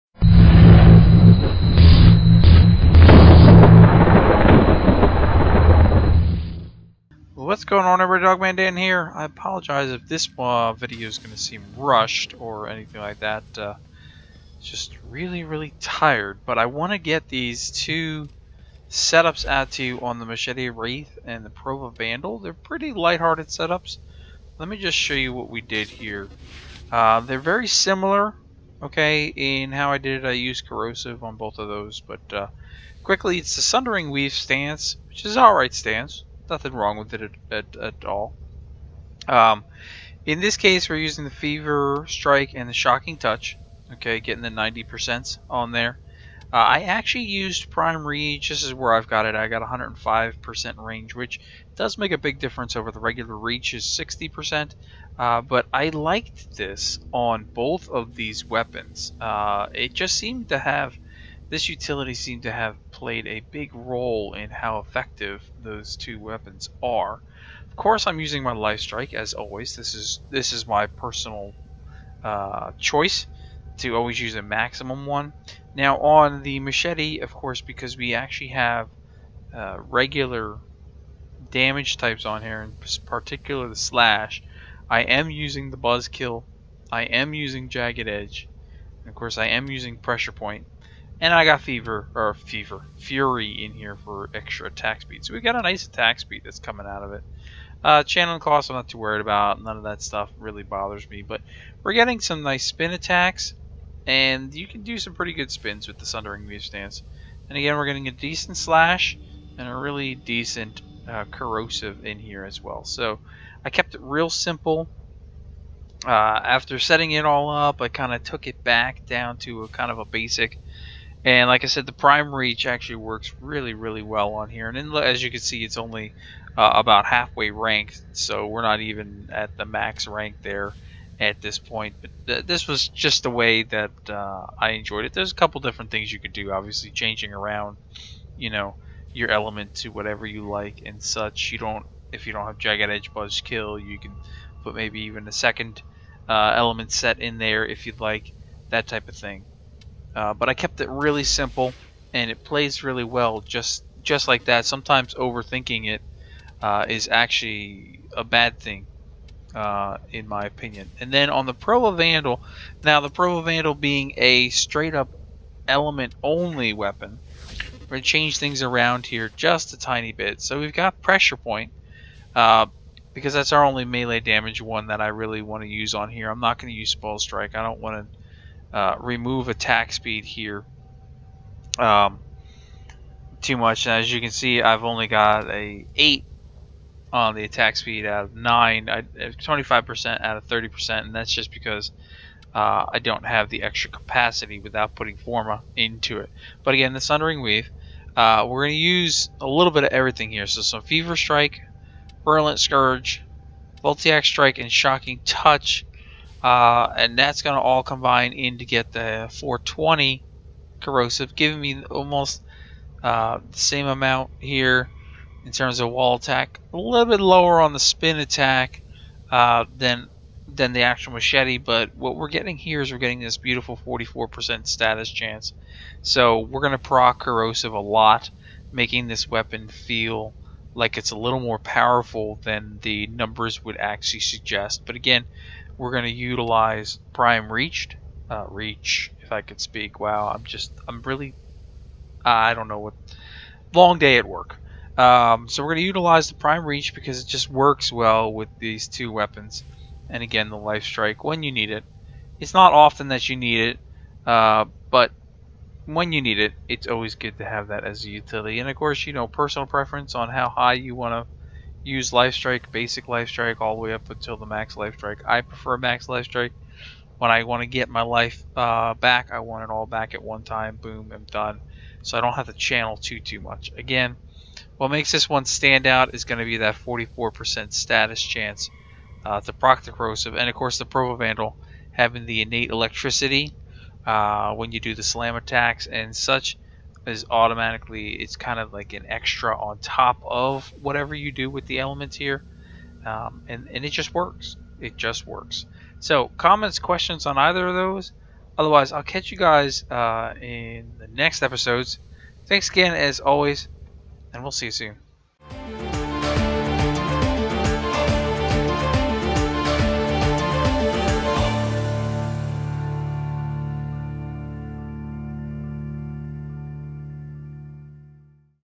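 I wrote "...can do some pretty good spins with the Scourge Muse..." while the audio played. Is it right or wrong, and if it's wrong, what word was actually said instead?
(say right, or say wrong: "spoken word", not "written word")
wrong: "Sundering", not "Scourge".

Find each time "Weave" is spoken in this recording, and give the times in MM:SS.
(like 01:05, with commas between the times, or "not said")
00:34, 03:17.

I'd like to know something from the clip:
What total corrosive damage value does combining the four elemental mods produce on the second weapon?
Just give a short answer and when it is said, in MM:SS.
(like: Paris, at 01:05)
420, at 03:29.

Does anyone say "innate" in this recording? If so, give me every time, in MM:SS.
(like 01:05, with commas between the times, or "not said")
04:42.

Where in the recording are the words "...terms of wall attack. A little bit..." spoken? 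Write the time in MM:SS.
03:35.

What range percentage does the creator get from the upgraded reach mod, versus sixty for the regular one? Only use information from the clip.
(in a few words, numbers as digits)
105%.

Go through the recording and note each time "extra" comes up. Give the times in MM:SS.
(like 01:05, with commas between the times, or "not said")
01:34, 03:13, 04:49.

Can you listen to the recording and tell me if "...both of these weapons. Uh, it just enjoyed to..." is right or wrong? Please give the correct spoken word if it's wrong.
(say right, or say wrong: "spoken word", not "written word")
wrong: "seemed", not "enjoyed".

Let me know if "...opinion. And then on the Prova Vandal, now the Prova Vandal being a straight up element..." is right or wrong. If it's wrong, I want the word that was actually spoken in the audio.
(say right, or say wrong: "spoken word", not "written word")
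right.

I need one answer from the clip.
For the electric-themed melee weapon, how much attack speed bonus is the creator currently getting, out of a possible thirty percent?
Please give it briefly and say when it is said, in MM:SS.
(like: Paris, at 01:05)
25%, at 03:08.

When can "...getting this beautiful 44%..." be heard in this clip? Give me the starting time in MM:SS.
03:42.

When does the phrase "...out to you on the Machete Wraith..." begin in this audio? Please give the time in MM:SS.
00:19.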